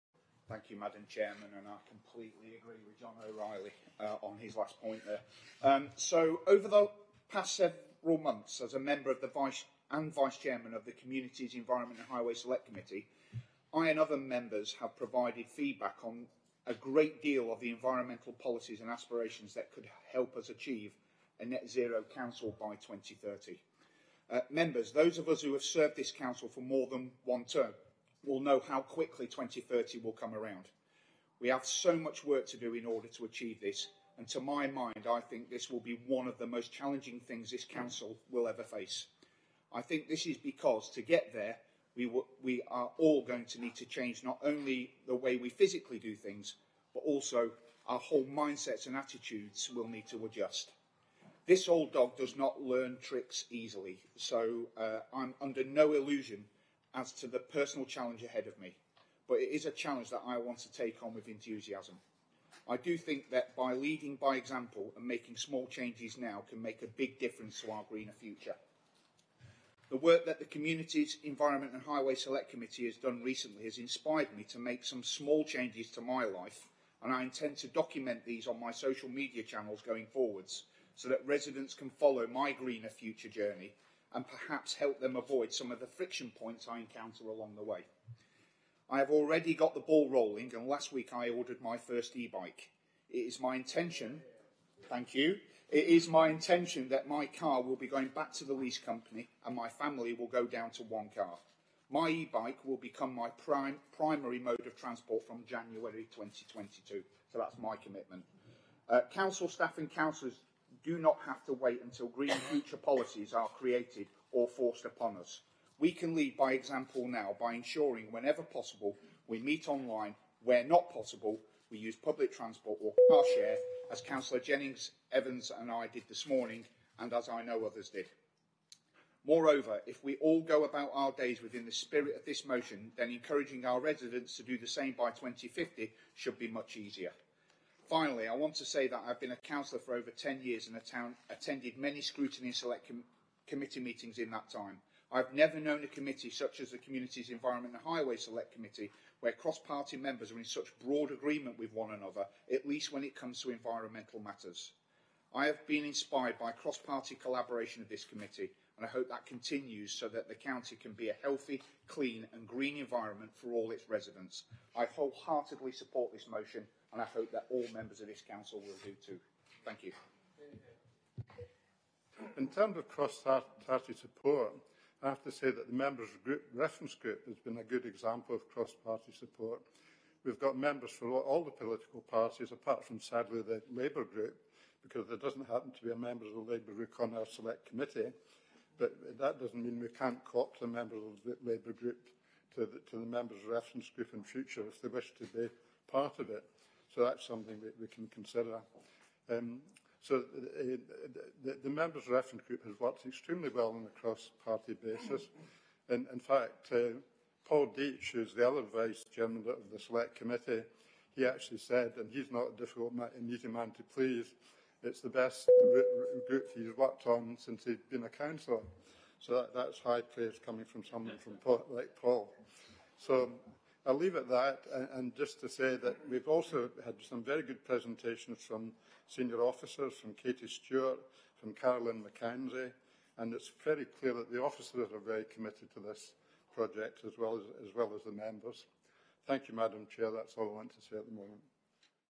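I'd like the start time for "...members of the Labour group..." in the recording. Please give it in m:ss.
3:10.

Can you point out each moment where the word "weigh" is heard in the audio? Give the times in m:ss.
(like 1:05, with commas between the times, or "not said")
not said.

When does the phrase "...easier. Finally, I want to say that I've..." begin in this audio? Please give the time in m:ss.
2:16.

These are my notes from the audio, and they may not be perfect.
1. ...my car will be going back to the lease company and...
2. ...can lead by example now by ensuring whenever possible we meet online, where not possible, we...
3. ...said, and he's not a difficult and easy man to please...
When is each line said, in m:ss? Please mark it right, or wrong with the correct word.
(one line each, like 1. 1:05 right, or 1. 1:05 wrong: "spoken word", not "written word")
1. 1:37 right
2. 1:55 right
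3. 3:31 right.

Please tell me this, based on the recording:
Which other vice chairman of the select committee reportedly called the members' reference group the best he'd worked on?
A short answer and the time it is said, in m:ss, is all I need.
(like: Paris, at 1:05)
Paul Deach, at 3:27.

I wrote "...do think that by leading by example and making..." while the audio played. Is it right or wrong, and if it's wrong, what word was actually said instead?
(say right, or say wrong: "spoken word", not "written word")
right.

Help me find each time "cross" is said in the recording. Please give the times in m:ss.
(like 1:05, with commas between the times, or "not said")
2:29, 2:36, 2:52, 2:58, 3:24.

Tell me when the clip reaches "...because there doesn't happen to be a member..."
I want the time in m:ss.
3:04.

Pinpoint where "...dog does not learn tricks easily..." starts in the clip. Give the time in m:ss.
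0:51.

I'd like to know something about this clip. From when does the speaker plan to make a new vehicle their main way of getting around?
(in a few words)
January 2022.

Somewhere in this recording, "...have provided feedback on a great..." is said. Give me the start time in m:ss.
0:14.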